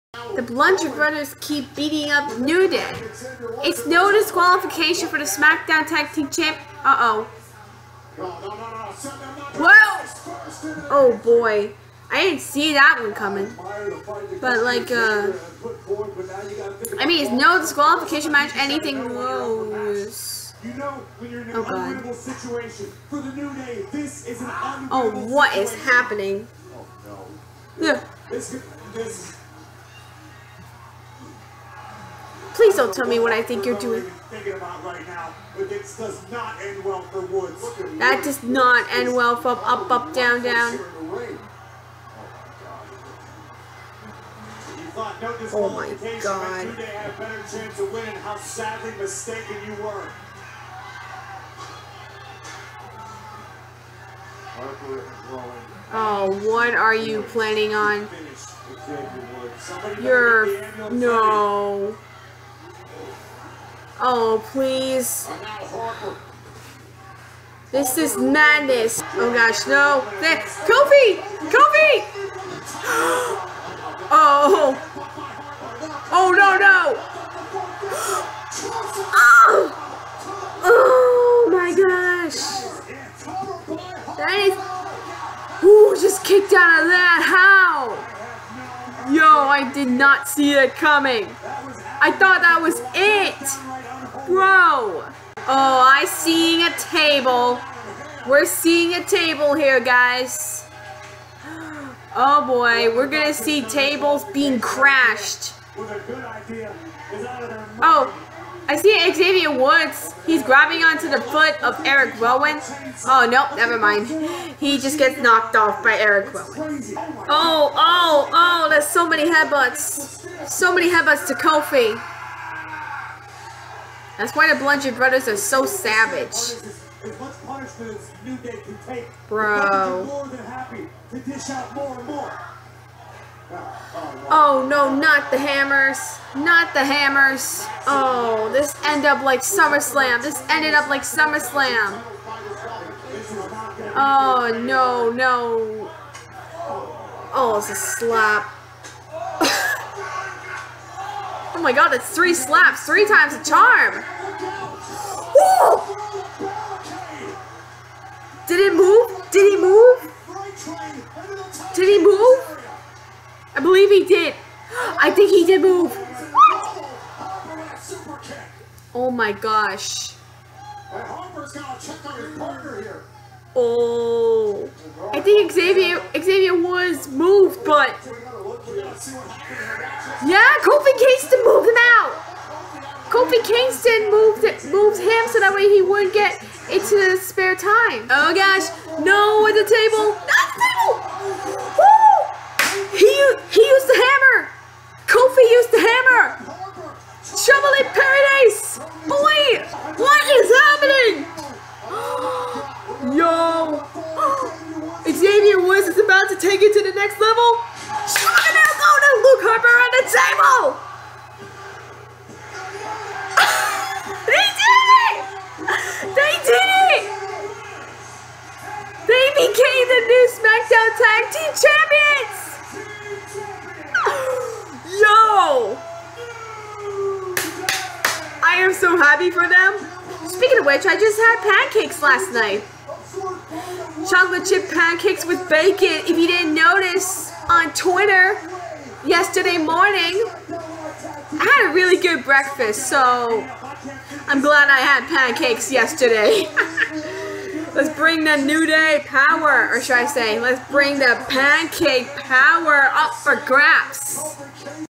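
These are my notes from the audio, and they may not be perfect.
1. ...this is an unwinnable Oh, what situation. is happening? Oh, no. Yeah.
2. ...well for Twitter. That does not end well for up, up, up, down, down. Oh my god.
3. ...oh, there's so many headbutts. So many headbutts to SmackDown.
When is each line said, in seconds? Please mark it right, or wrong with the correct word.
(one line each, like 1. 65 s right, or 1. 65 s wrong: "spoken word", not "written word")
1. 23 s right
2. 36 s wrong: "Woods", not "Twitter"
3. 118 s wrong: "Kofi", not "SmackDown".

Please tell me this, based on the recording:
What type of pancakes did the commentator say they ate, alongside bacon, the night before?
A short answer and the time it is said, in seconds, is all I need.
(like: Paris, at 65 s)
Chocolate chip, at 234 s.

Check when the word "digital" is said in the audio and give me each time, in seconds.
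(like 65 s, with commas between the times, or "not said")
not said.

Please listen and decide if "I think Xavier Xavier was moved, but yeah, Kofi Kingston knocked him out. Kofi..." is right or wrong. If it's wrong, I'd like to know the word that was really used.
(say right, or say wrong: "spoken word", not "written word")
wrong: "moved", not "knocked".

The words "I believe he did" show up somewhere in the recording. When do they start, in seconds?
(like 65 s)
163 s.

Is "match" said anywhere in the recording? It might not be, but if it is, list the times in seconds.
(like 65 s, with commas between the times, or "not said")
18 s.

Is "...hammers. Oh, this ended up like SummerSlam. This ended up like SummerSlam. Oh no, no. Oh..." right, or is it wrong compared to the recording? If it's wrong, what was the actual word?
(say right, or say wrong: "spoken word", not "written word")
right.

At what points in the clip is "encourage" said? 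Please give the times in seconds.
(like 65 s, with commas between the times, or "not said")
not said.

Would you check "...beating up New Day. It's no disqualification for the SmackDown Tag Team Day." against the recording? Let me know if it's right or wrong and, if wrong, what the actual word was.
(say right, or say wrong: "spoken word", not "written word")
wrong: "Champ", not "Day".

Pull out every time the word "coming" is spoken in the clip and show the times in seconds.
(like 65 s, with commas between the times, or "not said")
13 s, 90 s.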